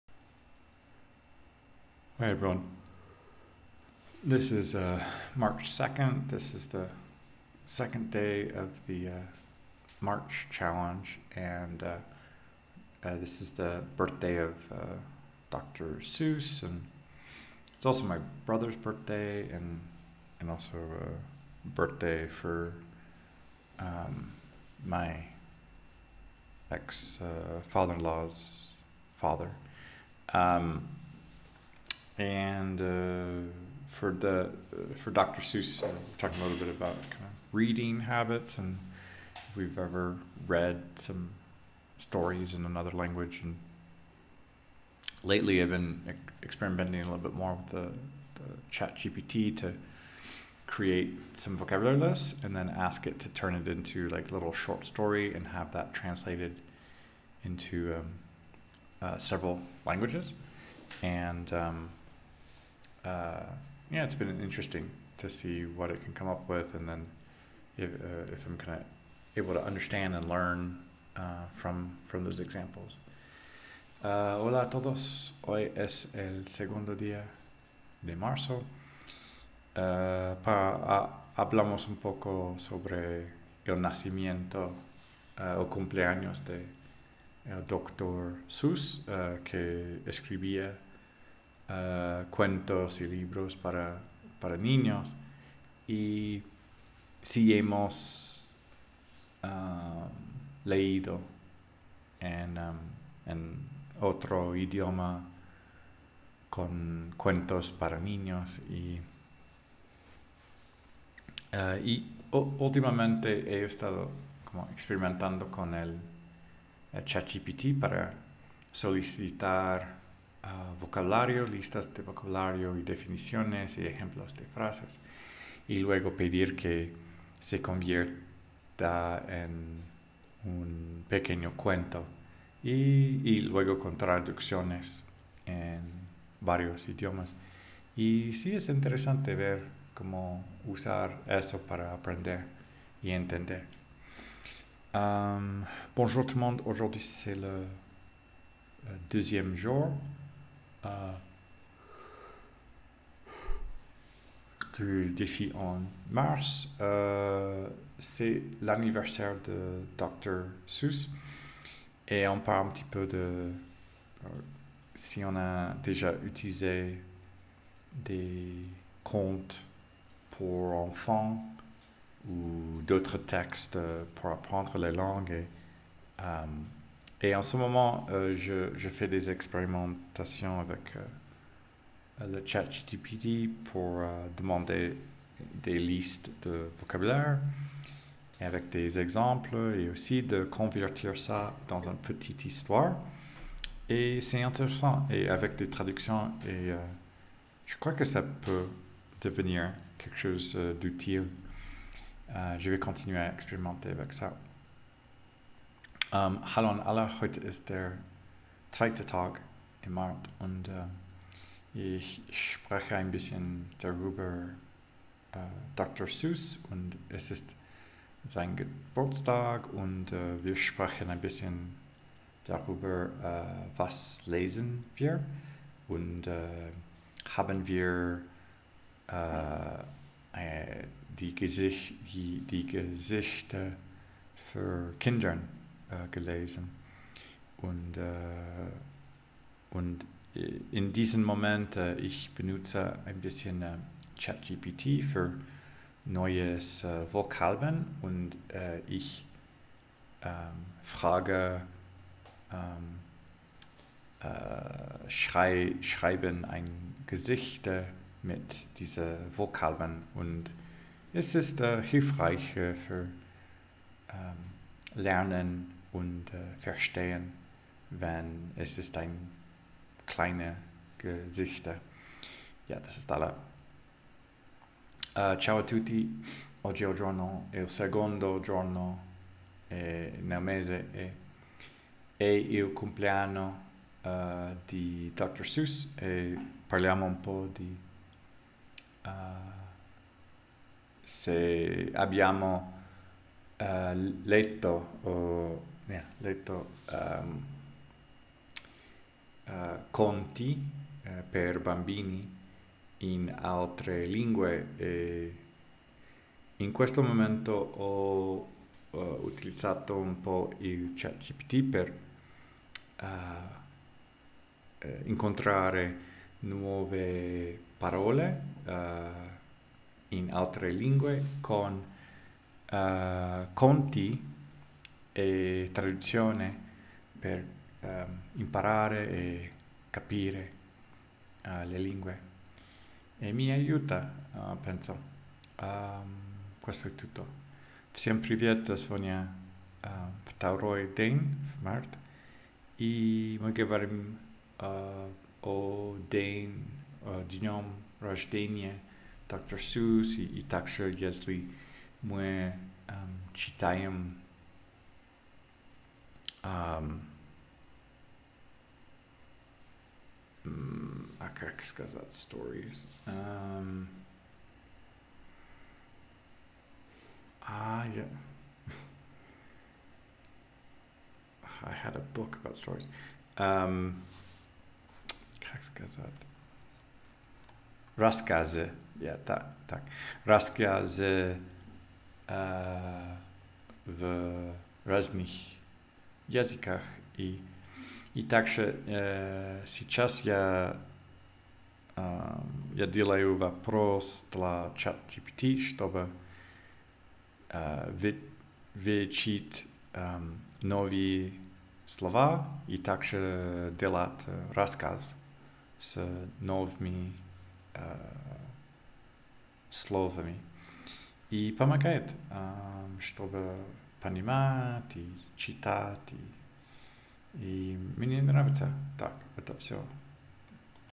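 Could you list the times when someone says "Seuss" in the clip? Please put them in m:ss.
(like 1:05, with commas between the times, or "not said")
0:16, 0:35, 1:28, 2:40, 3:36, 4:45.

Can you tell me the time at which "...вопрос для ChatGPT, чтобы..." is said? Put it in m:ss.
6:33.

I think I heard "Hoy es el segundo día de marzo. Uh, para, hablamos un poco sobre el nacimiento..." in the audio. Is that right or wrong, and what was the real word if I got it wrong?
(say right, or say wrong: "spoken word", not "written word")
right.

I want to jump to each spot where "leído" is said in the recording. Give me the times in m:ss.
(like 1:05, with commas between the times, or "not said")
1:40.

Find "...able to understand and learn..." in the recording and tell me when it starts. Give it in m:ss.
1:09.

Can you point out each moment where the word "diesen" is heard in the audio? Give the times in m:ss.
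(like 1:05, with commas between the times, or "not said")
4:00, 4:18.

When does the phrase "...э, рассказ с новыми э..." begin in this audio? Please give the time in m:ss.
6:44.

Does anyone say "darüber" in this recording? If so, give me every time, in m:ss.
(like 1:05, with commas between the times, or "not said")
3:33, 3:42.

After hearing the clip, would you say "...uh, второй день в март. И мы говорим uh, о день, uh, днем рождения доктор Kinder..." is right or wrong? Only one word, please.
wrong.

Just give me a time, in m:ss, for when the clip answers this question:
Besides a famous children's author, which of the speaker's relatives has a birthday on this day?
0:18.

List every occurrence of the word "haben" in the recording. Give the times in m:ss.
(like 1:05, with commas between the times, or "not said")
3:47.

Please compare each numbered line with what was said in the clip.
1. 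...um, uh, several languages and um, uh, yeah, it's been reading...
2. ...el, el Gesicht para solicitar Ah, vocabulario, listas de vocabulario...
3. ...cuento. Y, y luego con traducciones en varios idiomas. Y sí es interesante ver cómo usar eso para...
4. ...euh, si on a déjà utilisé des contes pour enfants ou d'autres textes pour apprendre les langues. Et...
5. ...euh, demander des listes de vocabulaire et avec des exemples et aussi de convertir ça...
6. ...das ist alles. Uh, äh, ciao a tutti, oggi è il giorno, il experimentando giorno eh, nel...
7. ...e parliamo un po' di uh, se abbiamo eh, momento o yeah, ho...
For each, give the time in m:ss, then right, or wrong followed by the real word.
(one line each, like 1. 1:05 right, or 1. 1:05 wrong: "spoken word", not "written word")
1. 0:57 wrong: "interesting", not "reading"
2. 1:55 wrong: "ChatGPT", not "Gesicht"
3. 2:11 right
4. 2:44 right
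5. 3:03 right
6. 4:32 wrong: "secondo", not "experimentando"
7. 4:45 wrong: "letto", not "momento".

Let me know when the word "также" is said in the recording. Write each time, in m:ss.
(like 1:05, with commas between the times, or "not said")
5:50, 6:28, 6:42.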